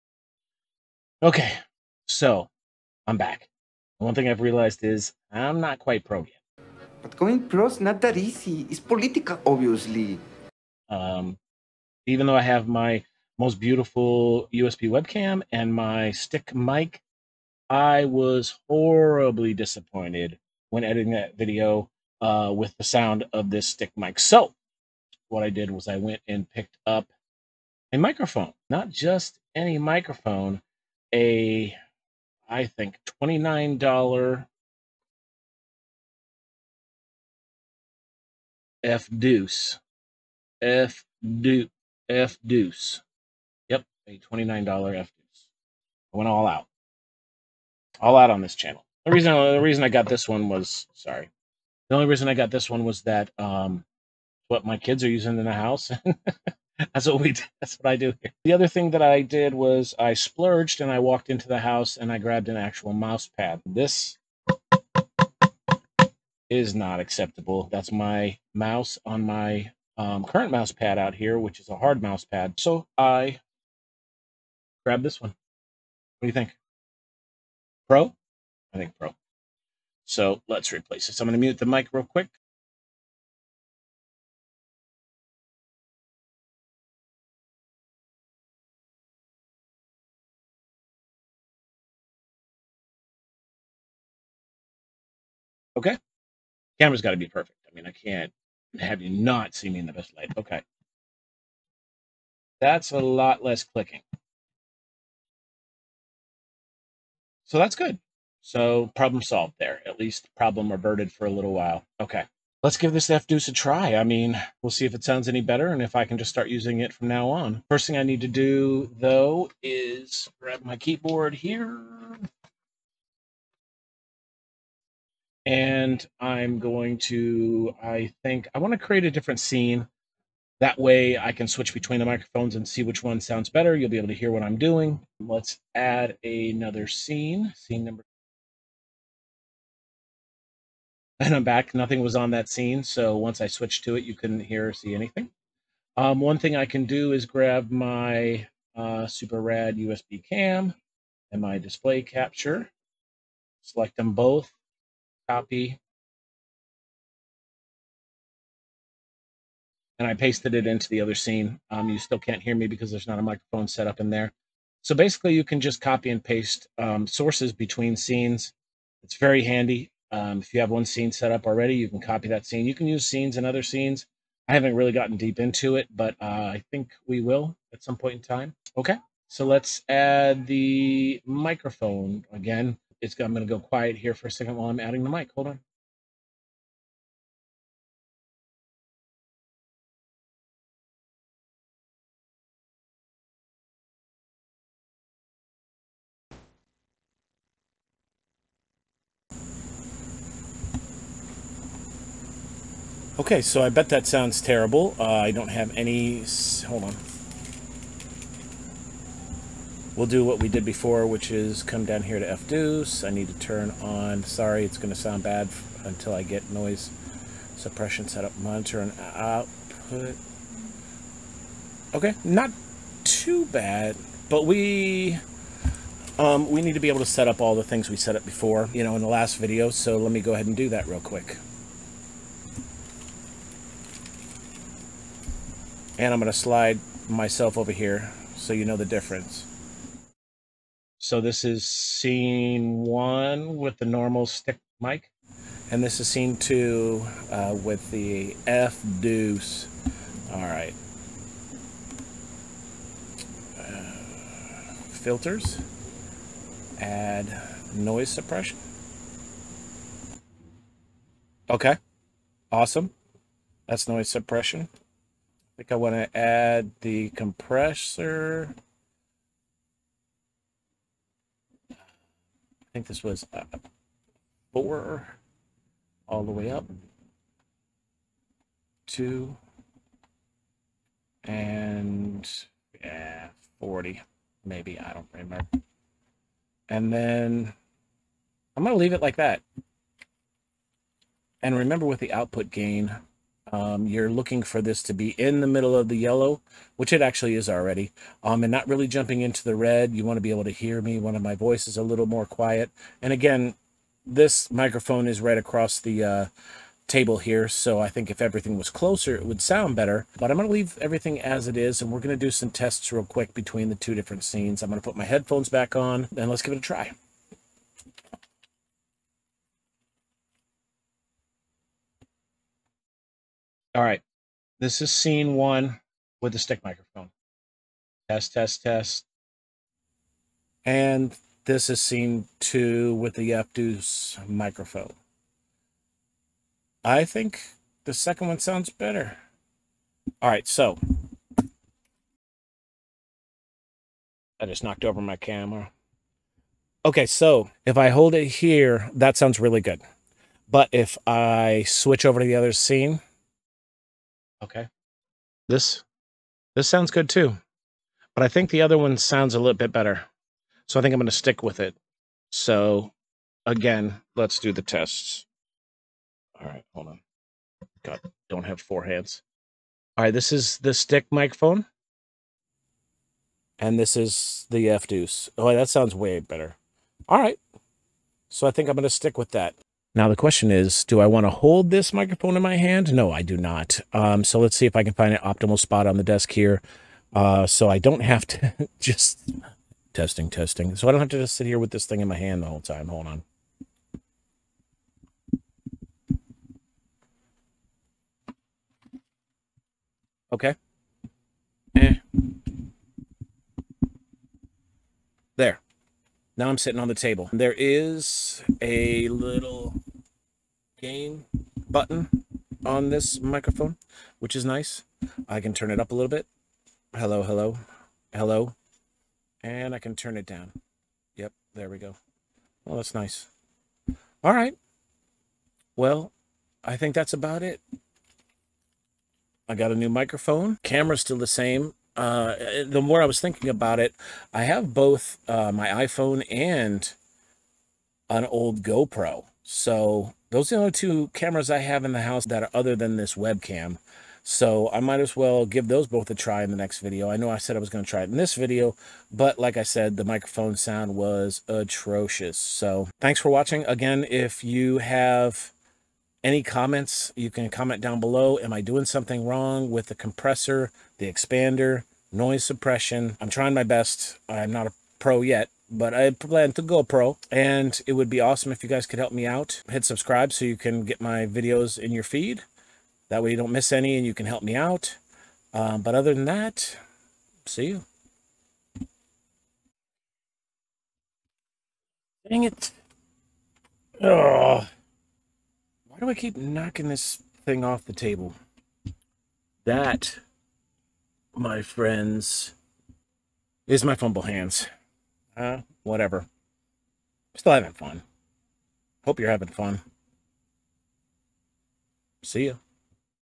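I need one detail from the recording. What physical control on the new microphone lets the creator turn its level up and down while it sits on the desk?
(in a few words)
gain button.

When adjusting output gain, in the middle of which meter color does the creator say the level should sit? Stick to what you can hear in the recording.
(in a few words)
yellow.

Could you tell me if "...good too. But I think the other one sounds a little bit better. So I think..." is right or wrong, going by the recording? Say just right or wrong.
right.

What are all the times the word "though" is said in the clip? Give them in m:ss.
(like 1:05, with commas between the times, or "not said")
0:12, 1:58.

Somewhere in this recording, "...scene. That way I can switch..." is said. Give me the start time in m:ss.
2:09.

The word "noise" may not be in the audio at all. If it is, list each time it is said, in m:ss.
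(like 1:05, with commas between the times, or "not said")
3:36, 4:17, 4:23, 7:42.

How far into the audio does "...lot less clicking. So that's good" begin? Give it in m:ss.
1:42.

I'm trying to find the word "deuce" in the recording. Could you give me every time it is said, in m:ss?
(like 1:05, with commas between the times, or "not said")
0:41, 4:09.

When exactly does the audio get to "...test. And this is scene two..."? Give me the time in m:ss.
5:28.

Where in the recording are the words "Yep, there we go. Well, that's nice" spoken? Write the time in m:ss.
7:01.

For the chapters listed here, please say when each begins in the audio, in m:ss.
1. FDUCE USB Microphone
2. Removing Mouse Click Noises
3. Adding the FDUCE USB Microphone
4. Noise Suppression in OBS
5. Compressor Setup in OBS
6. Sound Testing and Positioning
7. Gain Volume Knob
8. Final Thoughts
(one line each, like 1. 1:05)
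1. 0:28
2. 0:58
3. 2:58
4. 3:45
5. 4:25
6. 5:45
7. 6:45
8. 7:07.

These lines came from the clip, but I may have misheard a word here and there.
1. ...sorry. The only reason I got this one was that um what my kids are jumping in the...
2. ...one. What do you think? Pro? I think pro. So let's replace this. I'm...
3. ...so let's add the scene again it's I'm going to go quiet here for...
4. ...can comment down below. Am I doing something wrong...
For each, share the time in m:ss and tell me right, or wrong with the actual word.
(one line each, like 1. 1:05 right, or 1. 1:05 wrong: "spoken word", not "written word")
1. 0:50 wrong: "using", not "jumping"
2. 1:15 right
3. 2:59 wrong: "microphone", not "scene"
4. 7:37 right.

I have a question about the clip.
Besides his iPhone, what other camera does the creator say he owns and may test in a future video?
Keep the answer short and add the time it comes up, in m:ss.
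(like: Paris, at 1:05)
old GoPro, at 7:18.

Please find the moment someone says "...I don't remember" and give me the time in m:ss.
4:44.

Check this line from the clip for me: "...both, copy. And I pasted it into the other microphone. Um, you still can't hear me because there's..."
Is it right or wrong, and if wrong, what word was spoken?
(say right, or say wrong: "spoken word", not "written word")
wrong: "scene", not "microphone".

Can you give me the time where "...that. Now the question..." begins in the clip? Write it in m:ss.
6:19.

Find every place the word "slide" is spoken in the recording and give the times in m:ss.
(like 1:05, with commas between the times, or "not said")
3:56.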